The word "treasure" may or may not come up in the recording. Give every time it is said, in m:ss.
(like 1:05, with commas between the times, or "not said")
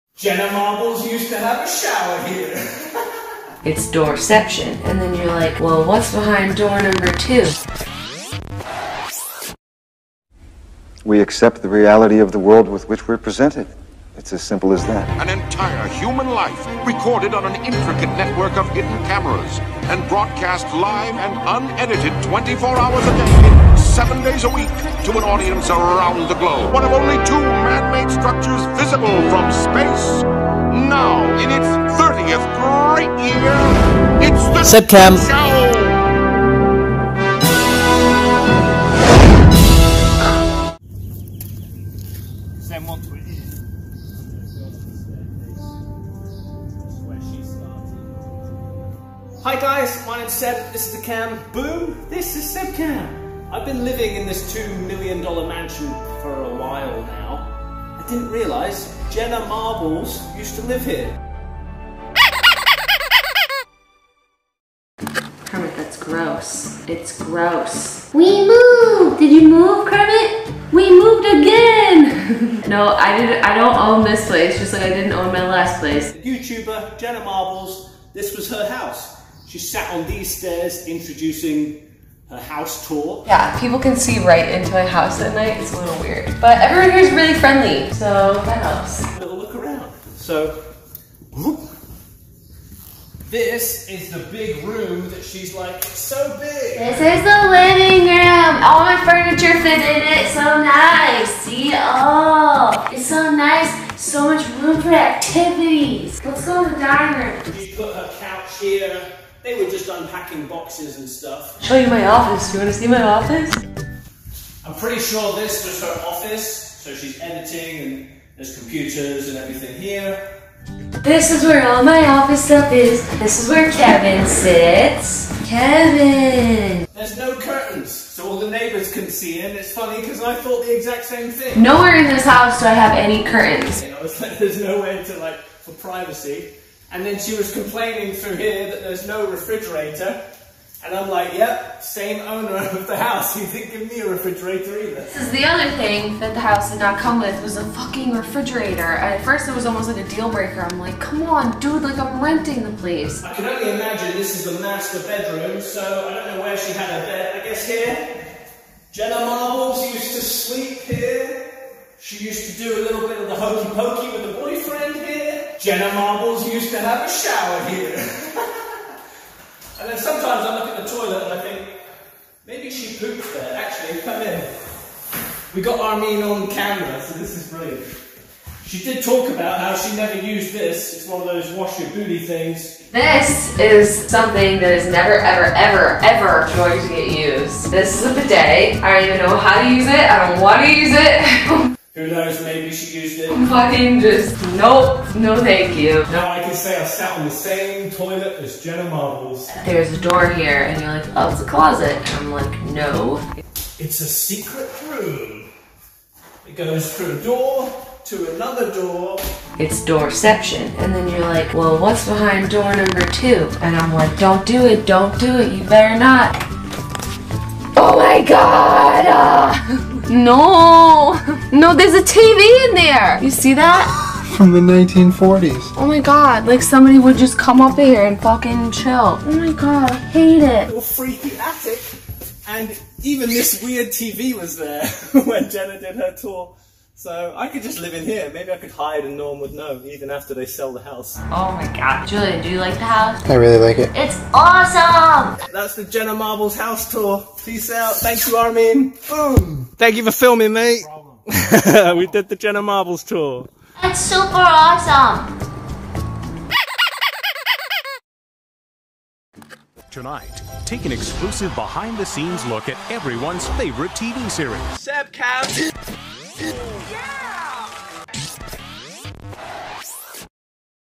not said.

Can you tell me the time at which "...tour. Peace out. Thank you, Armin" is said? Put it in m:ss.
4:06.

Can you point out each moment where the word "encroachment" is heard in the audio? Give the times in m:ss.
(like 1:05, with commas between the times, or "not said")
not said.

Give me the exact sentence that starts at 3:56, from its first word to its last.
So I could just live in here.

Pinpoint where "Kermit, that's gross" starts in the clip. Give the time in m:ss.
1:05.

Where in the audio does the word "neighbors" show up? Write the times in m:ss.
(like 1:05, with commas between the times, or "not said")
2:08.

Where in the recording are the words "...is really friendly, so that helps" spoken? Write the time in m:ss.
1:26.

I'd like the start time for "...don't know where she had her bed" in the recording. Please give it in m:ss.
2:36.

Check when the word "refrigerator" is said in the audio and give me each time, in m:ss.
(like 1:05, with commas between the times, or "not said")
2:19, 2:24, 2:28.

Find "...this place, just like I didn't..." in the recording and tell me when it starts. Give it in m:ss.
1:14.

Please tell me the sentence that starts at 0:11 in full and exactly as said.
We accept the reality of the world with which we're presented.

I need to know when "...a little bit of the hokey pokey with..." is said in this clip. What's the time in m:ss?
2:42.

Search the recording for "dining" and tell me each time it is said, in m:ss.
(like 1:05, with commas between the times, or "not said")
1:46.